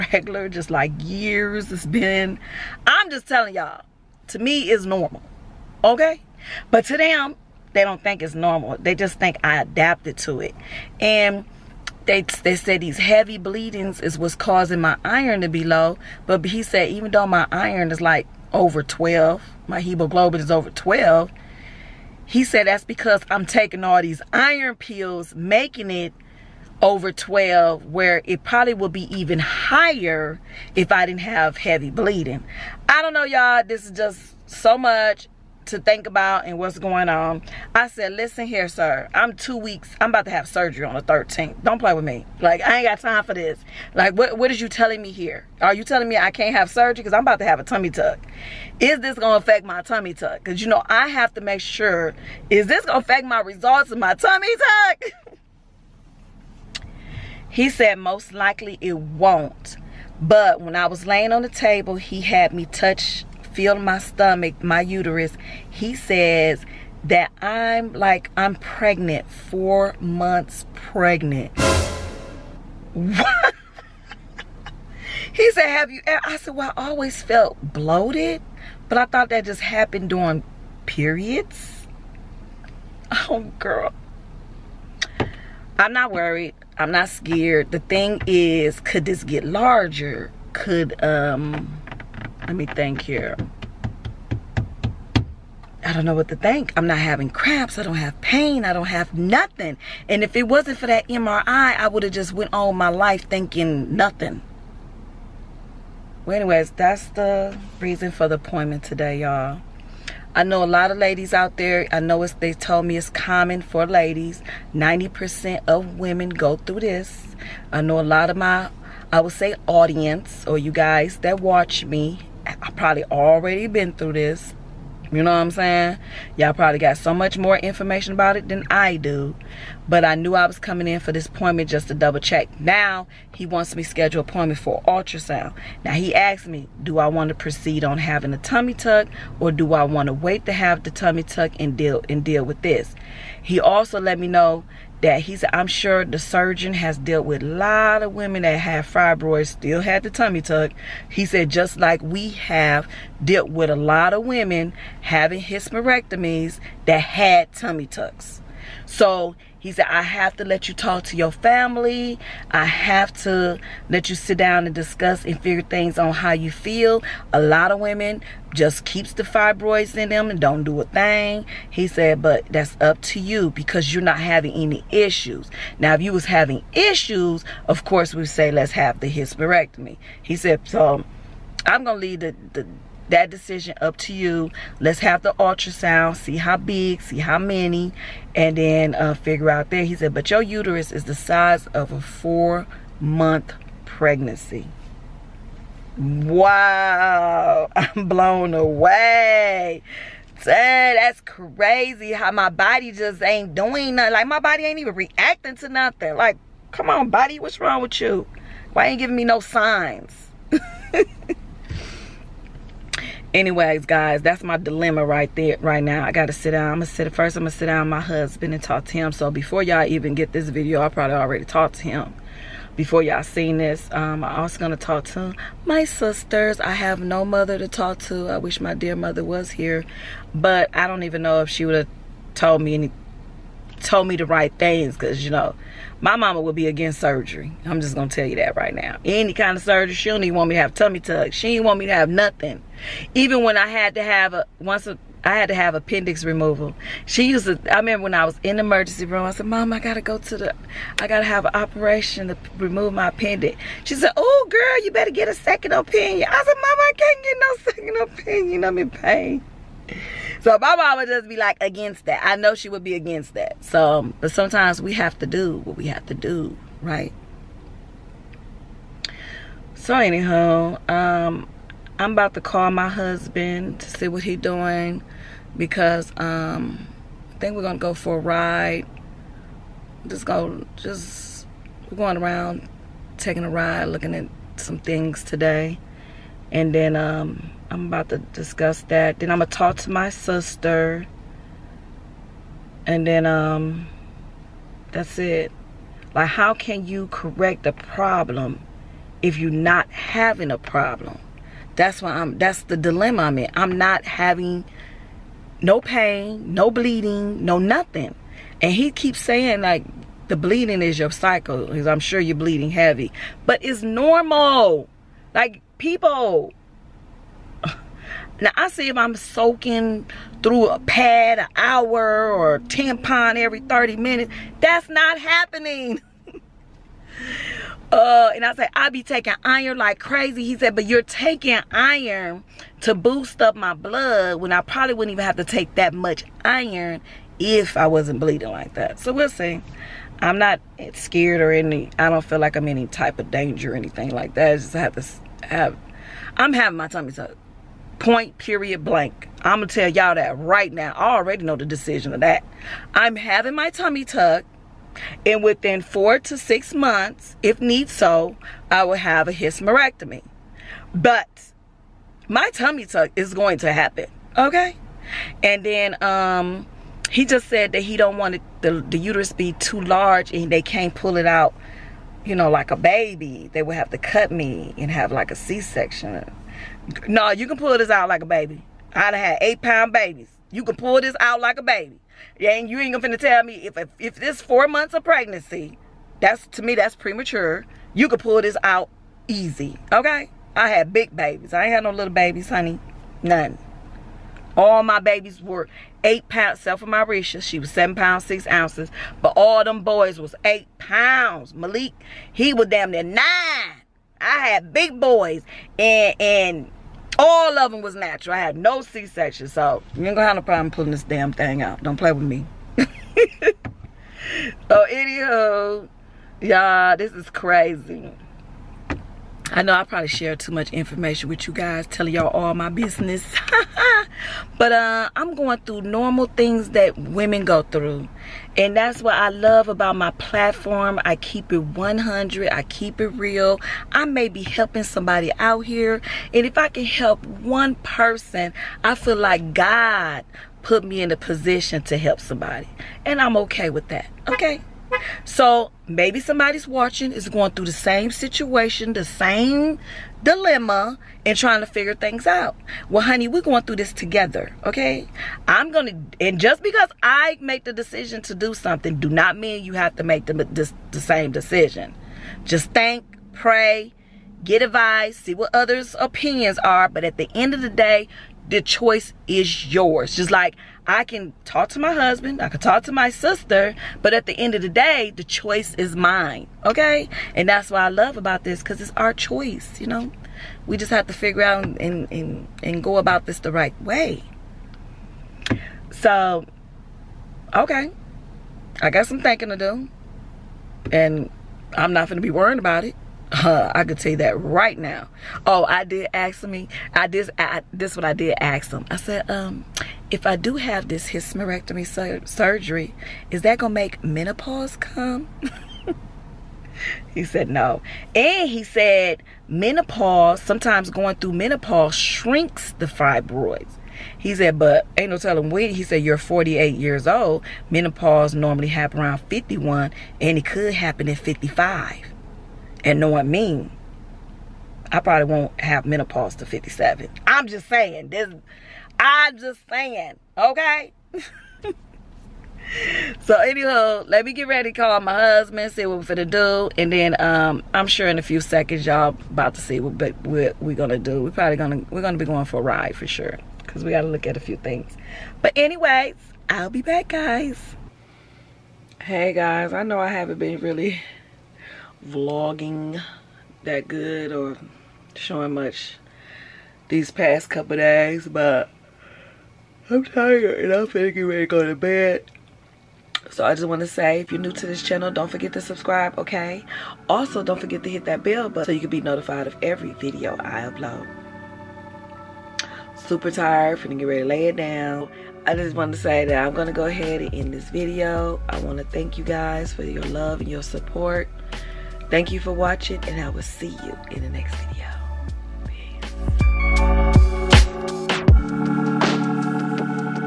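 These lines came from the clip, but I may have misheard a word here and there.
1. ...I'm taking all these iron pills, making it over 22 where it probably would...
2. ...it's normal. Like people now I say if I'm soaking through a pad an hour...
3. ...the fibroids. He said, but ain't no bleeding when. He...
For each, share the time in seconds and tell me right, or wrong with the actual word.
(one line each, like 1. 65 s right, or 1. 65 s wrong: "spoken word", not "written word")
1. 23 s wrong: "12", not "22"
2. 313 s right
3. 512 s wrong: "telling", not "bleeding".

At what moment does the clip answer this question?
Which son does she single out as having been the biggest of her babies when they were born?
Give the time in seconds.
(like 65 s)
401 s.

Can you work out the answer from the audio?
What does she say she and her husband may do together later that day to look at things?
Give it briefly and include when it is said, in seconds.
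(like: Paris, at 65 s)
Go for a ride, at 277 s.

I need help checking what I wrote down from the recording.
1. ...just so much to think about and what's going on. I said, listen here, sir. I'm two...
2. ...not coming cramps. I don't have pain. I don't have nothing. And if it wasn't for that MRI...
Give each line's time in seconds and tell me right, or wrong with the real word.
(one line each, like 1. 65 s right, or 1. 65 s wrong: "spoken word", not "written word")
1. 33 s right
2. 96 s wrong: "having", not "coming".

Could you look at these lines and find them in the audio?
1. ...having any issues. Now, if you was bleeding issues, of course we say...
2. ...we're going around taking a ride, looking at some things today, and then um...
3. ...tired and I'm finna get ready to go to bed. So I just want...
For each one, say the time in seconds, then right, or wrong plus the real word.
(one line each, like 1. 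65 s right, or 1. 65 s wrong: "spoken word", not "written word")
1. 174 s wrong: "having", not "bleeding"
2. 281 s right
3. 560 s right.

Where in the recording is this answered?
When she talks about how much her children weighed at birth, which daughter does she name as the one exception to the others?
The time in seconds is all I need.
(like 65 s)
396 s.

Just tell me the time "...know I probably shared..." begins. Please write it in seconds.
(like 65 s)
419 s.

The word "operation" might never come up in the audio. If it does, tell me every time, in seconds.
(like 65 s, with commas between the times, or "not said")
251 s.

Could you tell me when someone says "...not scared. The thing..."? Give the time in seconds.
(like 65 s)
86 s.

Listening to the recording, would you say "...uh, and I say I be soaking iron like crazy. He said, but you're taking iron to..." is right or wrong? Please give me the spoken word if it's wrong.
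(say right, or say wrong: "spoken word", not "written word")
wrong: "taking", not "soaking".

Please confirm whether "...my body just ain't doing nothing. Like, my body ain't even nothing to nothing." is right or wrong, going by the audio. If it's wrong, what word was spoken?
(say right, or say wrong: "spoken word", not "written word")
wrong: "reacting", not "nothing".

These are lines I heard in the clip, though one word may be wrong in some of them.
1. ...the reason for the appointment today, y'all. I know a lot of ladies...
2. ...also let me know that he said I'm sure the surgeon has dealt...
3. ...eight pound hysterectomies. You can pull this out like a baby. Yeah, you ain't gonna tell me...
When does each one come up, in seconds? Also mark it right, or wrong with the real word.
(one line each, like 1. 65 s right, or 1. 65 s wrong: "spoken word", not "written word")
1. 107 s right
2. 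143 s right
3. 379 s wrong: "babies", not "hysterectomies".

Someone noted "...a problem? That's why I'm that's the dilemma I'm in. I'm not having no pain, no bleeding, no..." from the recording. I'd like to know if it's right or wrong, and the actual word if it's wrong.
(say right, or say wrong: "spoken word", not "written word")
right.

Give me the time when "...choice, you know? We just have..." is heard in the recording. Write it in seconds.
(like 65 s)
479 s.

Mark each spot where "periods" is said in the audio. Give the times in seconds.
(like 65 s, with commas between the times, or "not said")
80 s, 348 s.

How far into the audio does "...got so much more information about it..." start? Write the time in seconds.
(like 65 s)
126 s.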